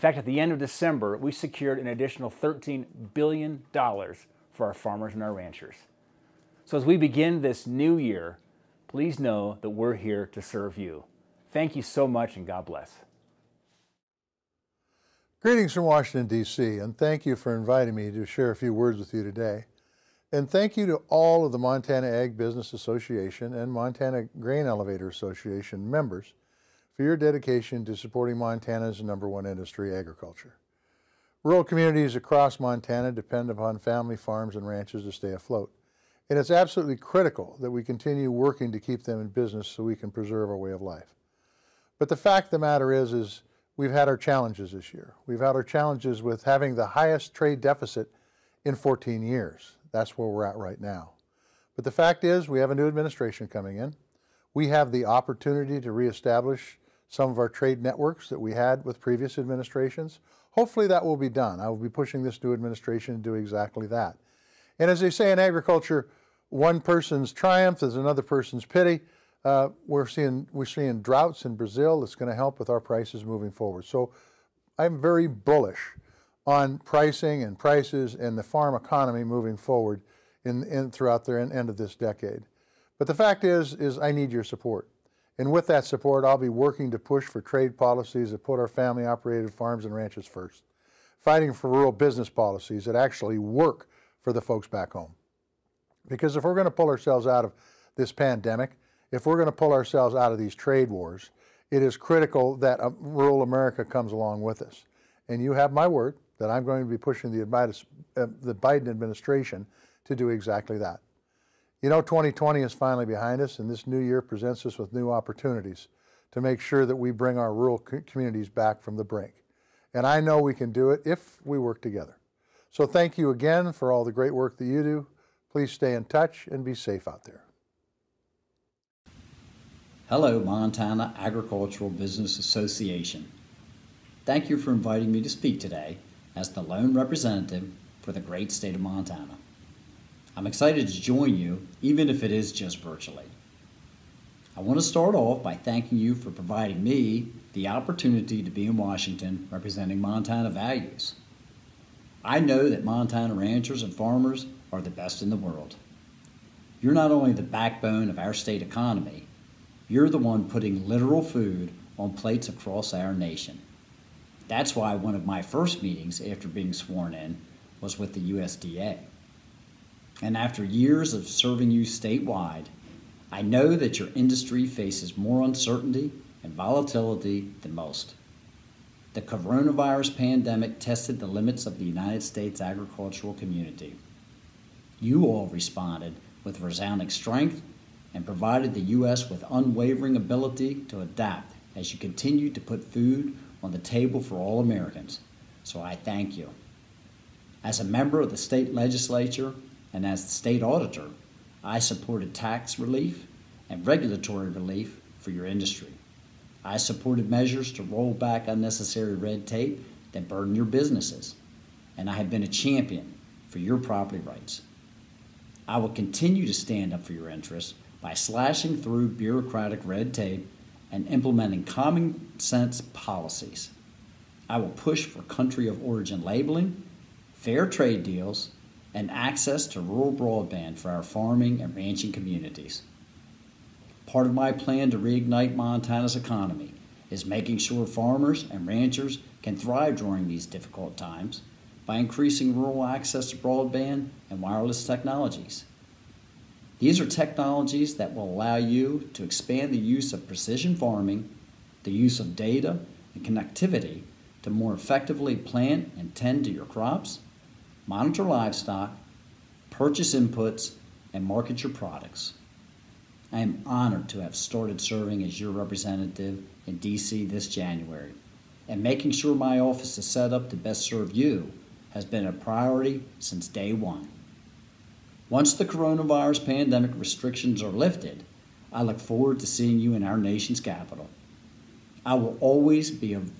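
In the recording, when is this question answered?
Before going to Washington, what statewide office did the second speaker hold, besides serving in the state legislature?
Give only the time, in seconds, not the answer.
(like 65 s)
200 s.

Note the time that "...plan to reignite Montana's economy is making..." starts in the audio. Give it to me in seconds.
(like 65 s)
234 s.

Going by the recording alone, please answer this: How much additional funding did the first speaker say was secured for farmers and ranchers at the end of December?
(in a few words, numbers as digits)
$13 billion.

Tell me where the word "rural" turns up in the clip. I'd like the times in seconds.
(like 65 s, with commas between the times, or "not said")
31 s, 91 s, 102 s, 117 s, 229 s, 242 s.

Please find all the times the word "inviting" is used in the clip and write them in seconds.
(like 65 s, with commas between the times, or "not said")
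17 s, 134 s.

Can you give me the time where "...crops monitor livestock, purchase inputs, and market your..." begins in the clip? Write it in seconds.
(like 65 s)
256 s.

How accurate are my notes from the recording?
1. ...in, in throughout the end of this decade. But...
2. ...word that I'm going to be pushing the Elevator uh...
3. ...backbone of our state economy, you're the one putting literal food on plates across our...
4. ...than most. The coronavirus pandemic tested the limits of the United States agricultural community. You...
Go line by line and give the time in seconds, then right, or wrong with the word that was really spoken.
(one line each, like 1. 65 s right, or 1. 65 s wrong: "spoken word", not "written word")
1. 80 s right
2. 105 s wrong: "Biden", not "Elevator"
3. 157 s right
4. 177 s right.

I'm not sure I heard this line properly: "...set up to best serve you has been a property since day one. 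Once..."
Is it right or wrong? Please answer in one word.
wrong.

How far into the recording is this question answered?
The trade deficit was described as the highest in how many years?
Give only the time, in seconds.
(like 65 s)
48 s.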